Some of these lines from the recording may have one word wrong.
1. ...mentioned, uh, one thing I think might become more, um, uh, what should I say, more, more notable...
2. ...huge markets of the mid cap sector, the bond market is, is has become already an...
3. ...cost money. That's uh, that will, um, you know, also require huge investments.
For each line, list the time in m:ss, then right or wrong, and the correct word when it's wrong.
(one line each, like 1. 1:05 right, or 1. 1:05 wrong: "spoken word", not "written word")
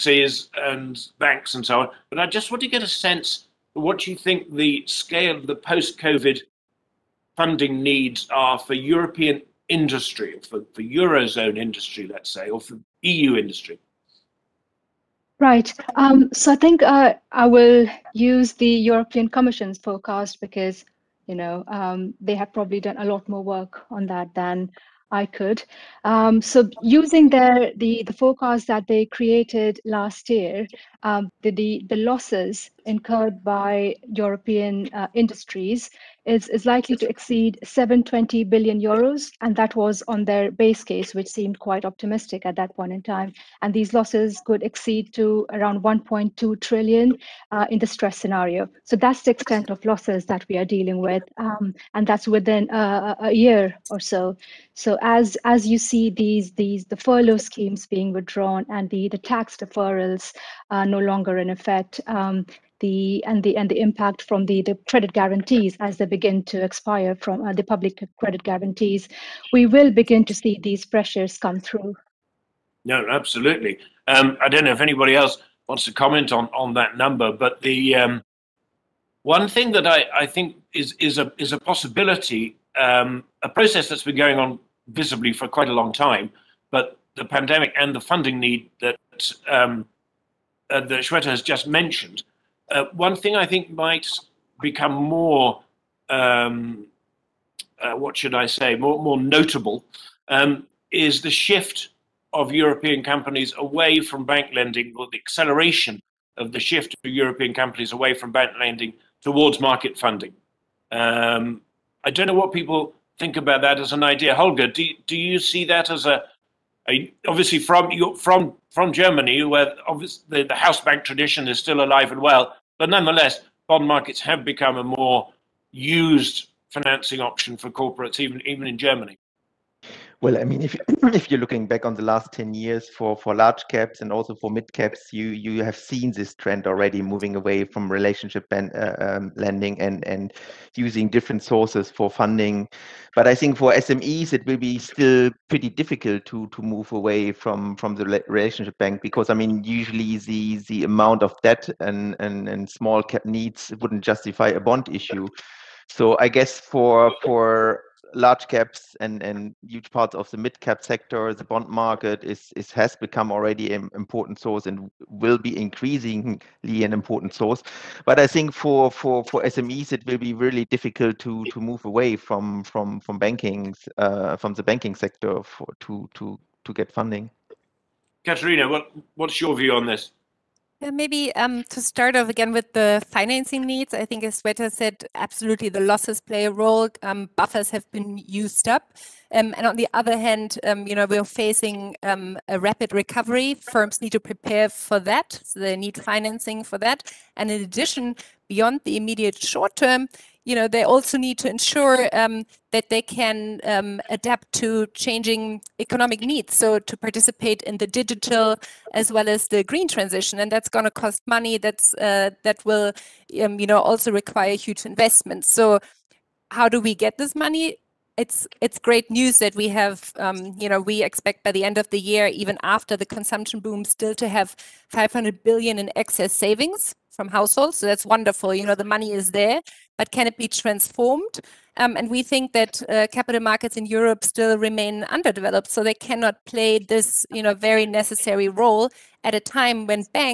1. 1:31 right
2. 2:39 wrong: "parts", not "markets"
3. 3:30 right.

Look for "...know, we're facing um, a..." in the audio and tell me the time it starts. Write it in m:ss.
3:10.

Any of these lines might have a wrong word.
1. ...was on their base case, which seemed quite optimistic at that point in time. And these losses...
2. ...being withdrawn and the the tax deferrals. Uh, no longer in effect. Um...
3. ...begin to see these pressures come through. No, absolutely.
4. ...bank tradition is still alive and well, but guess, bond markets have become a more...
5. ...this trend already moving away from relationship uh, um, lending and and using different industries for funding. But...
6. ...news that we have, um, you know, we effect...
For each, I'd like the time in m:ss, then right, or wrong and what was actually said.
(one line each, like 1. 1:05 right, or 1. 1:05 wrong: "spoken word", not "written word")
1. 0:39 right
2. 0:57 right
3. 1:09 right
4. 2:00 wrong: "nonetheless", not "guess"
5. 2:16 wrong: "sources", not "industries"
6. 3:39 wrong: "expect", not "effect".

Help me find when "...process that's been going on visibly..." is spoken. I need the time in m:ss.
1:23.